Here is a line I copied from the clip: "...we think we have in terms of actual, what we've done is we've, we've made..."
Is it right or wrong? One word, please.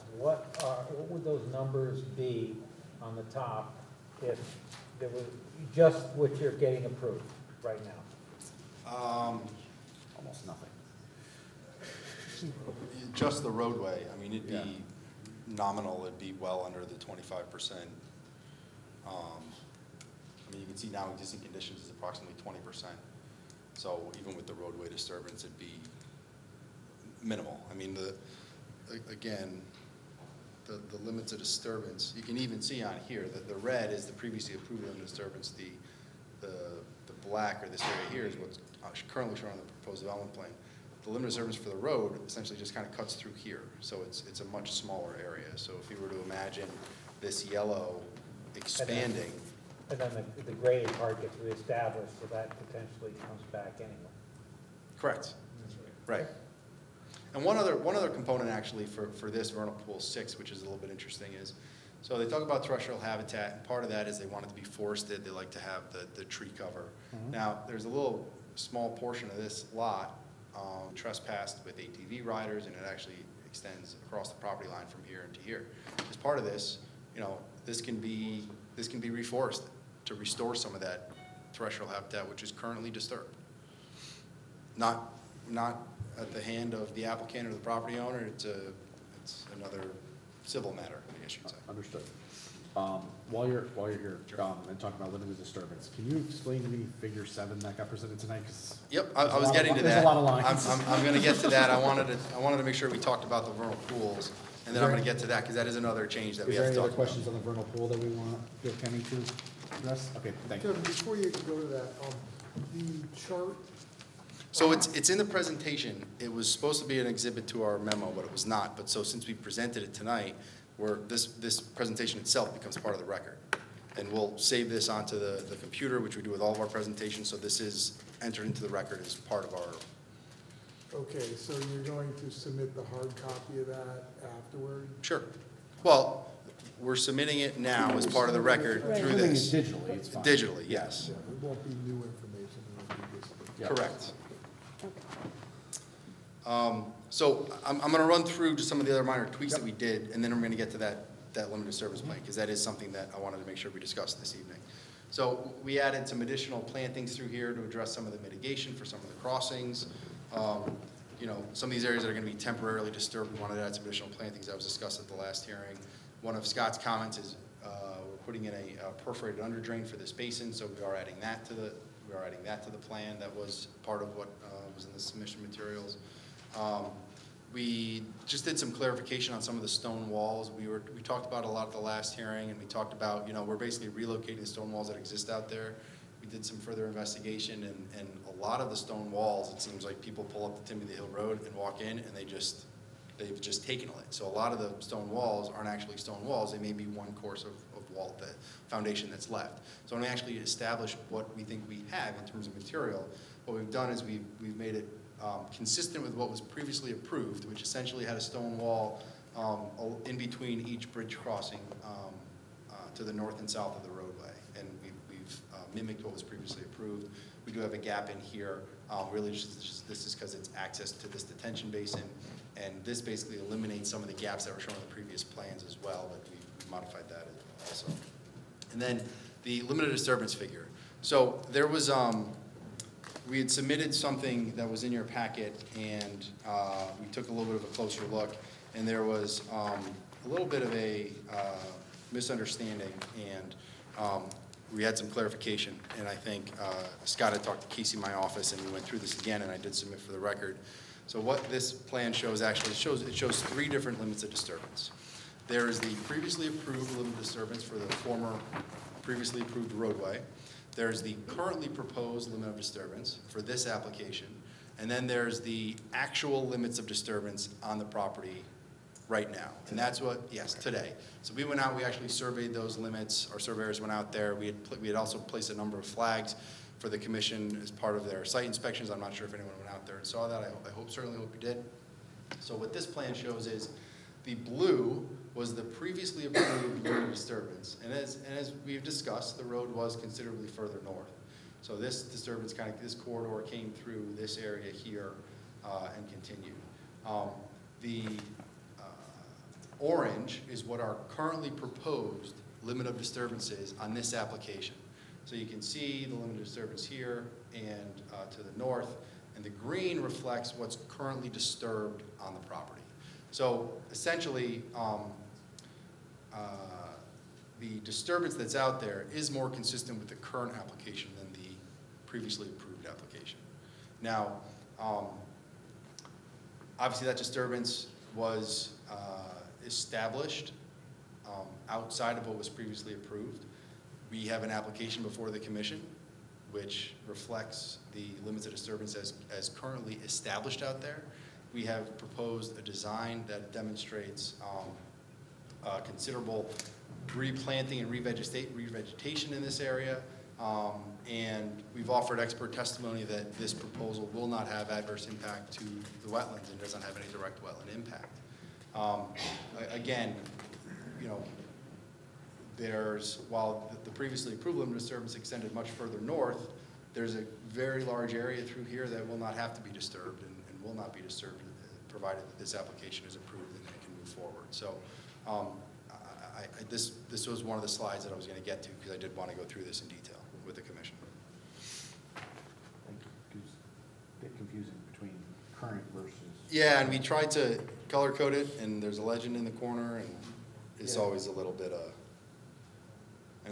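wrong.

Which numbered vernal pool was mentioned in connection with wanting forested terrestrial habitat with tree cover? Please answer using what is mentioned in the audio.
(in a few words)
6.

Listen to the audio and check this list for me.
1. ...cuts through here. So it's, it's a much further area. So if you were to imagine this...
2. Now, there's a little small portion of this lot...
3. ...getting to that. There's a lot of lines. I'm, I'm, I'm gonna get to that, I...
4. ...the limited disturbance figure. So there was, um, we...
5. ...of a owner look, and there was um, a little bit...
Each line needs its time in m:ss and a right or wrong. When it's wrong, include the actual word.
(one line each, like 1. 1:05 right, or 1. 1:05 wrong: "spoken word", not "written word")
1. 0:42 wrong: "smaller", not "further"
2. 1:07 right
3. 1:39 right
4. 3:49 right
5. 3:57 wrong: "closer", not "owner".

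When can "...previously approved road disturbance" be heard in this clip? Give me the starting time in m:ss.
4:45.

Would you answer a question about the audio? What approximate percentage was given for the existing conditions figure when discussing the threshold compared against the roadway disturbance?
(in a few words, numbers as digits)
20%.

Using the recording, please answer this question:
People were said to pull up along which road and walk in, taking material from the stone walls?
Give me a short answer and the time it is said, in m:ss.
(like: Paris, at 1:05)
Timothy Hill Road, at 3:10.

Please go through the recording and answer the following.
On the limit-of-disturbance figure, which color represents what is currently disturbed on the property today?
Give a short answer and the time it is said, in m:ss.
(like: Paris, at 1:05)
Green, at 5:09.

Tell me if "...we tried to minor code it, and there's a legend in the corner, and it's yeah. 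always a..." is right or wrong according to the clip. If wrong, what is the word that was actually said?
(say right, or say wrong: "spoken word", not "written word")
wrong: "color", not "minor".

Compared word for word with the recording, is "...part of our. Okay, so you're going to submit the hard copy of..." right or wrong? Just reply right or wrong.
right.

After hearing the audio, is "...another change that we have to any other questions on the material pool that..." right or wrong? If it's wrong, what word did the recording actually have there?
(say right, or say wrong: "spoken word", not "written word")
wrong: "vernal", not "material".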